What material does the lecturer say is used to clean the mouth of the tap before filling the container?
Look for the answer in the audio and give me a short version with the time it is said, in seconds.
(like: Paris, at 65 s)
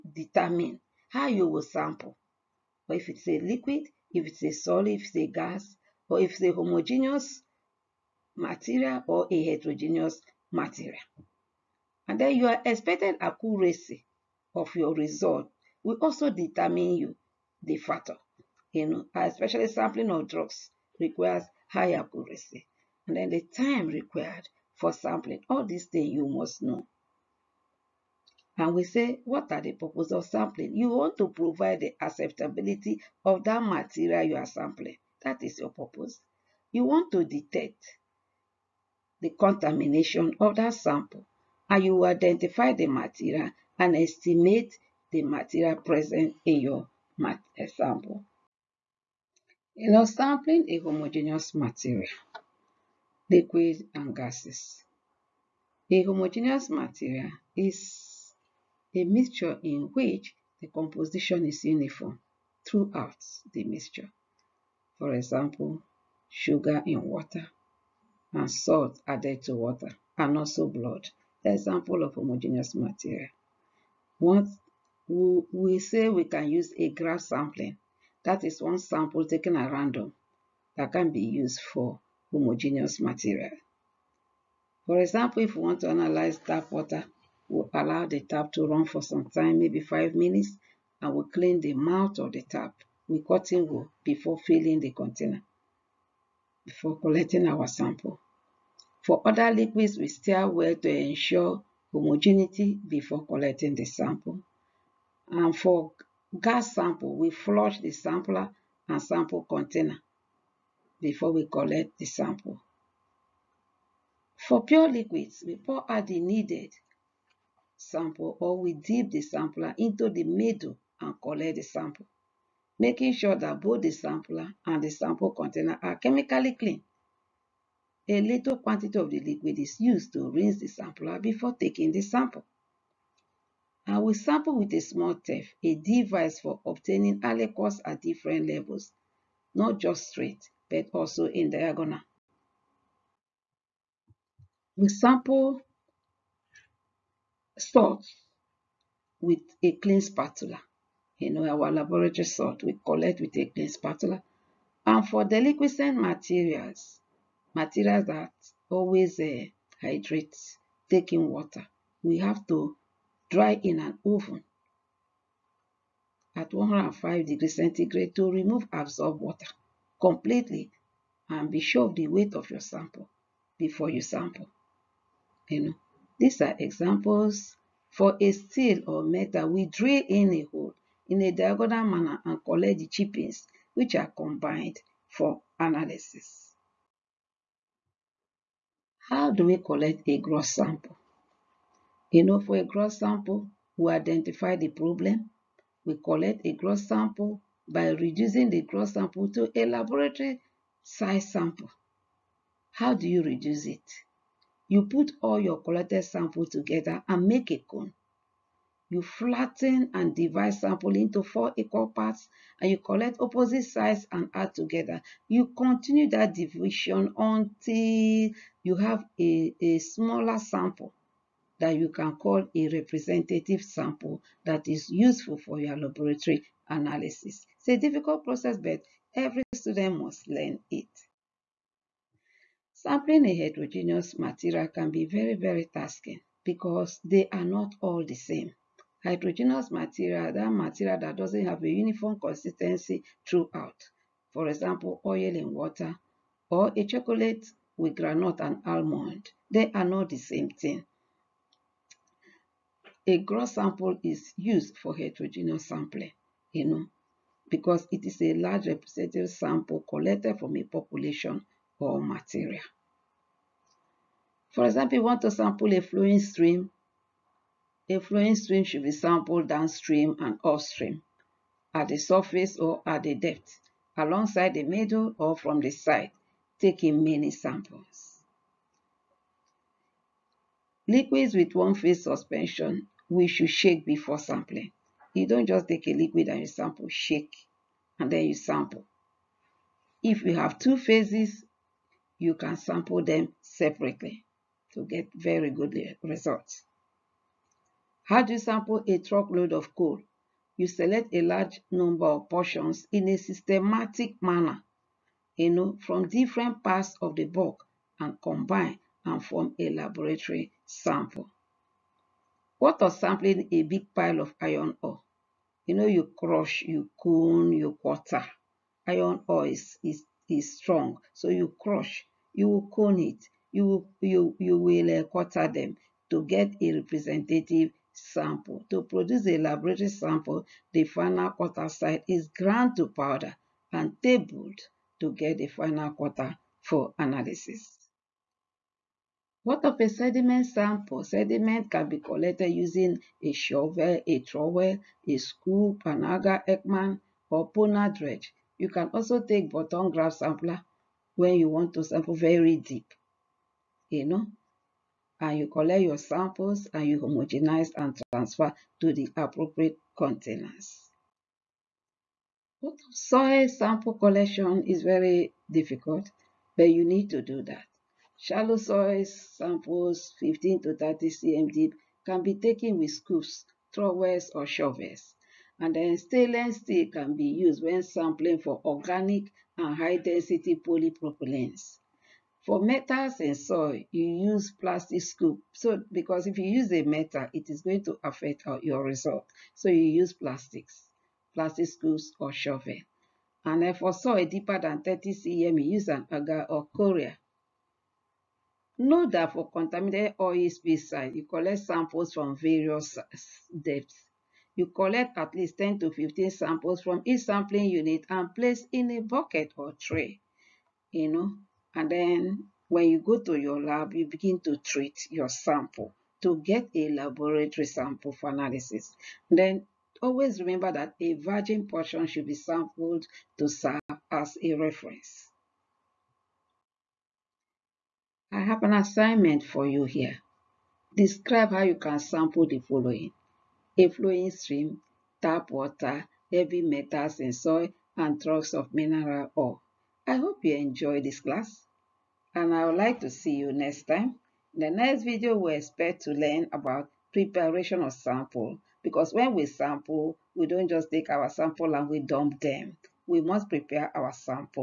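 Cotton wool, at 93 s.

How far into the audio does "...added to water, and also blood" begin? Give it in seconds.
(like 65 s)
69 s.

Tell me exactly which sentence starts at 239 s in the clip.
Hydrogenous material, that material that doesn't have a uniform consistency throughout.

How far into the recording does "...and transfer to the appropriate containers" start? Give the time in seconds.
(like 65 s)
357 s.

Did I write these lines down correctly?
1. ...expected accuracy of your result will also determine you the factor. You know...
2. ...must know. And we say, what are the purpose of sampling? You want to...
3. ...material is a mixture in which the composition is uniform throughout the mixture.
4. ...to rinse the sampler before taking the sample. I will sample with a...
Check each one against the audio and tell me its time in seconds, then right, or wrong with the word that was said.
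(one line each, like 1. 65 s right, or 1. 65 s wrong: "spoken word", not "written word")
1. 12 s right
2. 26 s right
3. 56 s right
4. 130 s right.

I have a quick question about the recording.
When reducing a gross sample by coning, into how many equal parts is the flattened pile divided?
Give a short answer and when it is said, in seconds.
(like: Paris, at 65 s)
4, at 211 s.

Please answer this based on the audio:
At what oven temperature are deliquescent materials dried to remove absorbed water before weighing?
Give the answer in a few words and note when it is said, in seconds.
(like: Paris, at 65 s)
105 degrees centigrade, at 166 s.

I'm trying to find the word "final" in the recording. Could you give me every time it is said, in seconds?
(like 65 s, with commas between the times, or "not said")
330 s, 335 s.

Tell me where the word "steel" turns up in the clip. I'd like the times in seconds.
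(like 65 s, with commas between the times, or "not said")
178 s, 376 s.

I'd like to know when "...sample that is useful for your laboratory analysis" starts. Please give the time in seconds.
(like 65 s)
223 s.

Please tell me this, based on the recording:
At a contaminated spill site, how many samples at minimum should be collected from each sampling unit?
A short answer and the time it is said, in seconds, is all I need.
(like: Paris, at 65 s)
10 to 15, at 405 s.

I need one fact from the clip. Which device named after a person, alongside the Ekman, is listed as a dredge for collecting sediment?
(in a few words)
Ponar dredge.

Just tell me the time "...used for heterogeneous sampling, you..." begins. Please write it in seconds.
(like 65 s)
254 s.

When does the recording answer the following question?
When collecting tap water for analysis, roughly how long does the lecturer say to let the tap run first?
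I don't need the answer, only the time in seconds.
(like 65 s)
89 s.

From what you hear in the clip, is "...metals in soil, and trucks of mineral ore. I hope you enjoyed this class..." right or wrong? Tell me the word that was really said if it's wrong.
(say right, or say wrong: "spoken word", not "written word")
right.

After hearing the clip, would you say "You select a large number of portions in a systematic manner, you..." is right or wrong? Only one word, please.
right.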